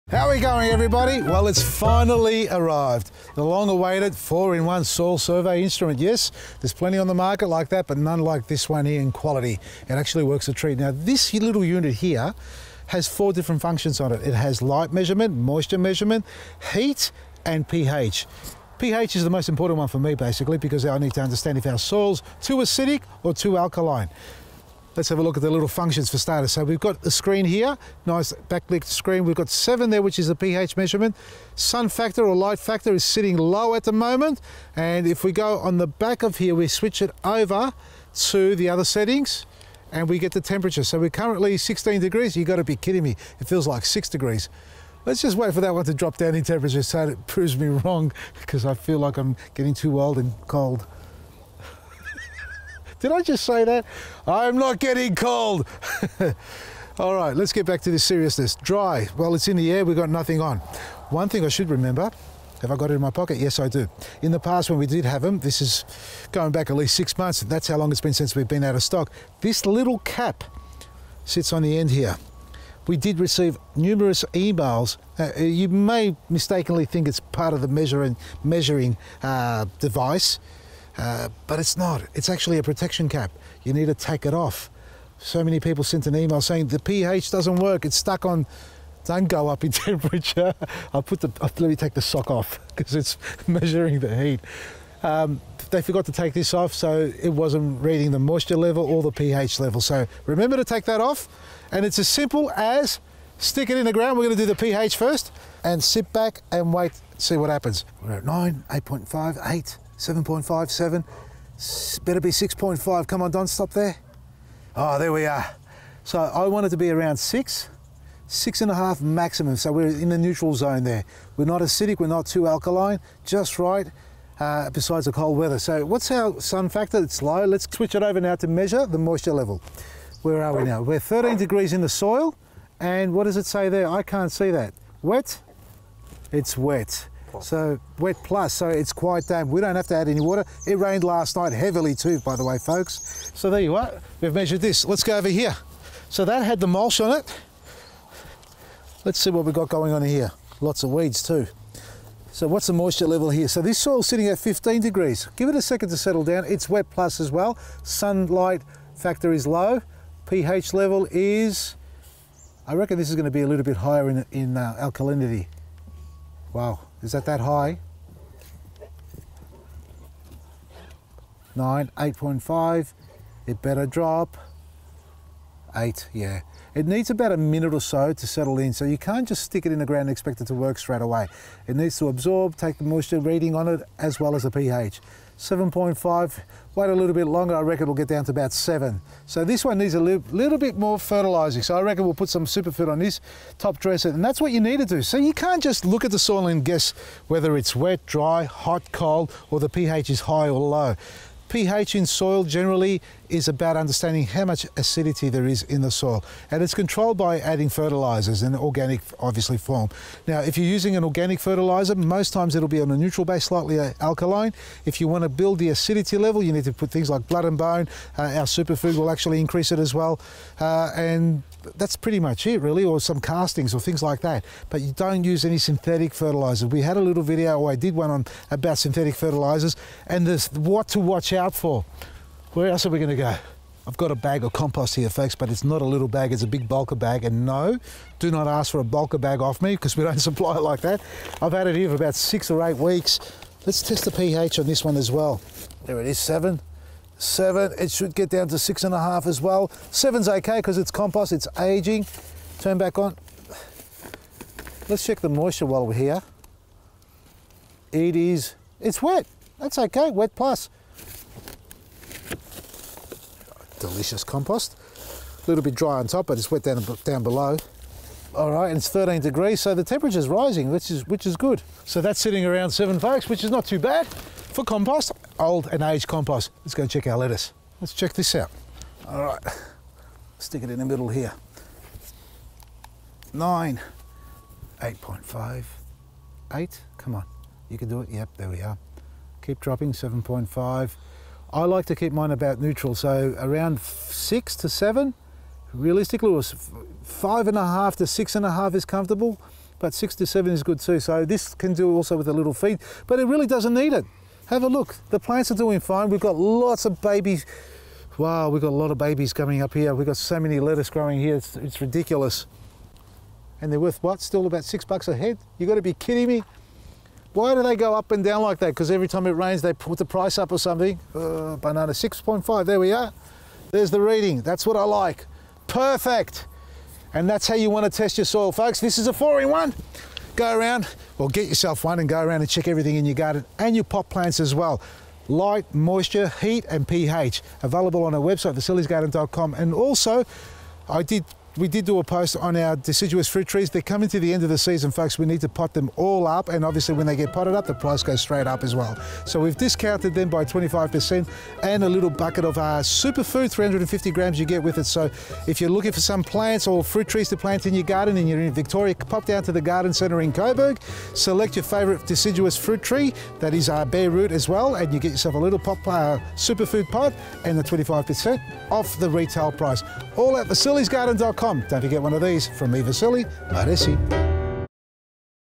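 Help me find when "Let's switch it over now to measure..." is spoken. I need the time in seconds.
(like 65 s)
127 s.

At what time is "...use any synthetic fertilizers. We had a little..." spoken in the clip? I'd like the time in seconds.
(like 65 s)
225 s.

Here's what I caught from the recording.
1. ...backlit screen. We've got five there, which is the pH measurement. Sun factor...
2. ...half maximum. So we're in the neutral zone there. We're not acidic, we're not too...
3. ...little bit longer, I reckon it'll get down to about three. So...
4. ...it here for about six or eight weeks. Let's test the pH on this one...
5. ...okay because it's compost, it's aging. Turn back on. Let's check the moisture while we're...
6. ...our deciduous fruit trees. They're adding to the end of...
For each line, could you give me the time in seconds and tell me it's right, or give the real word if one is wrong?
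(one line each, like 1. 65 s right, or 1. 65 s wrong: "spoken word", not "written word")
1. 28 s wrong: "seven", not "five"
2. 118 s right
3. 186 s wrong: "seven", not "three"
4. 241 s right
5. 250 s right
6. 342 s wrong: "coming", not "adding".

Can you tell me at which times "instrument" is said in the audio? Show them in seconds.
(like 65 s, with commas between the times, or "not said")
5 s.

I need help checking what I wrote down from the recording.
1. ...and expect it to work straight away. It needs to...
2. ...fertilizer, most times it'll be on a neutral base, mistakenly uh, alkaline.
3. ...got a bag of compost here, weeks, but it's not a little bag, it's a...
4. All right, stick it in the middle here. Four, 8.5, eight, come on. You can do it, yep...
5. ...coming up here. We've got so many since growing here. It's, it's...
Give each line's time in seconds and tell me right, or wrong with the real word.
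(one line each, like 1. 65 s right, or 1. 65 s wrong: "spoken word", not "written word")
1. 180 s right
2. 211 s wrong: "slightly", not "mistakenly"
3. 233 s wrong: "folks", not "weeks"
4. 279 s wrong: "Nine", not "Four"
5. 309 s wrong: "lettuce", not "since".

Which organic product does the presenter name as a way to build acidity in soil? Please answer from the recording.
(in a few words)
blood and bone.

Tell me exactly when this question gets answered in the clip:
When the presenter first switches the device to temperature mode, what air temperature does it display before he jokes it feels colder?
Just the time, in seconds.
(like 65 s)
41 s.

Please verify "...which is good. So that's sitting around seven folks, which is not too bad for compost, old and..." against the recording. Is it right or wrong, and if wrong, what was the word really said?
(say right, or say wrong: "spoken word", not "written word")
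right.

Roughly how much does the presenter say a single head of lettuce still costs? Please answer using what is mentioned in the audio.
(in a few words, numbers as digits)
6 bucks.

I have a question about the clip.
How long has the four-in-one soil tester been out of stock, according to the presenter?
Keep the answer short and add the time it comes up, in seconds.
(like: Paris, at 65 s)
six months, at 66 s.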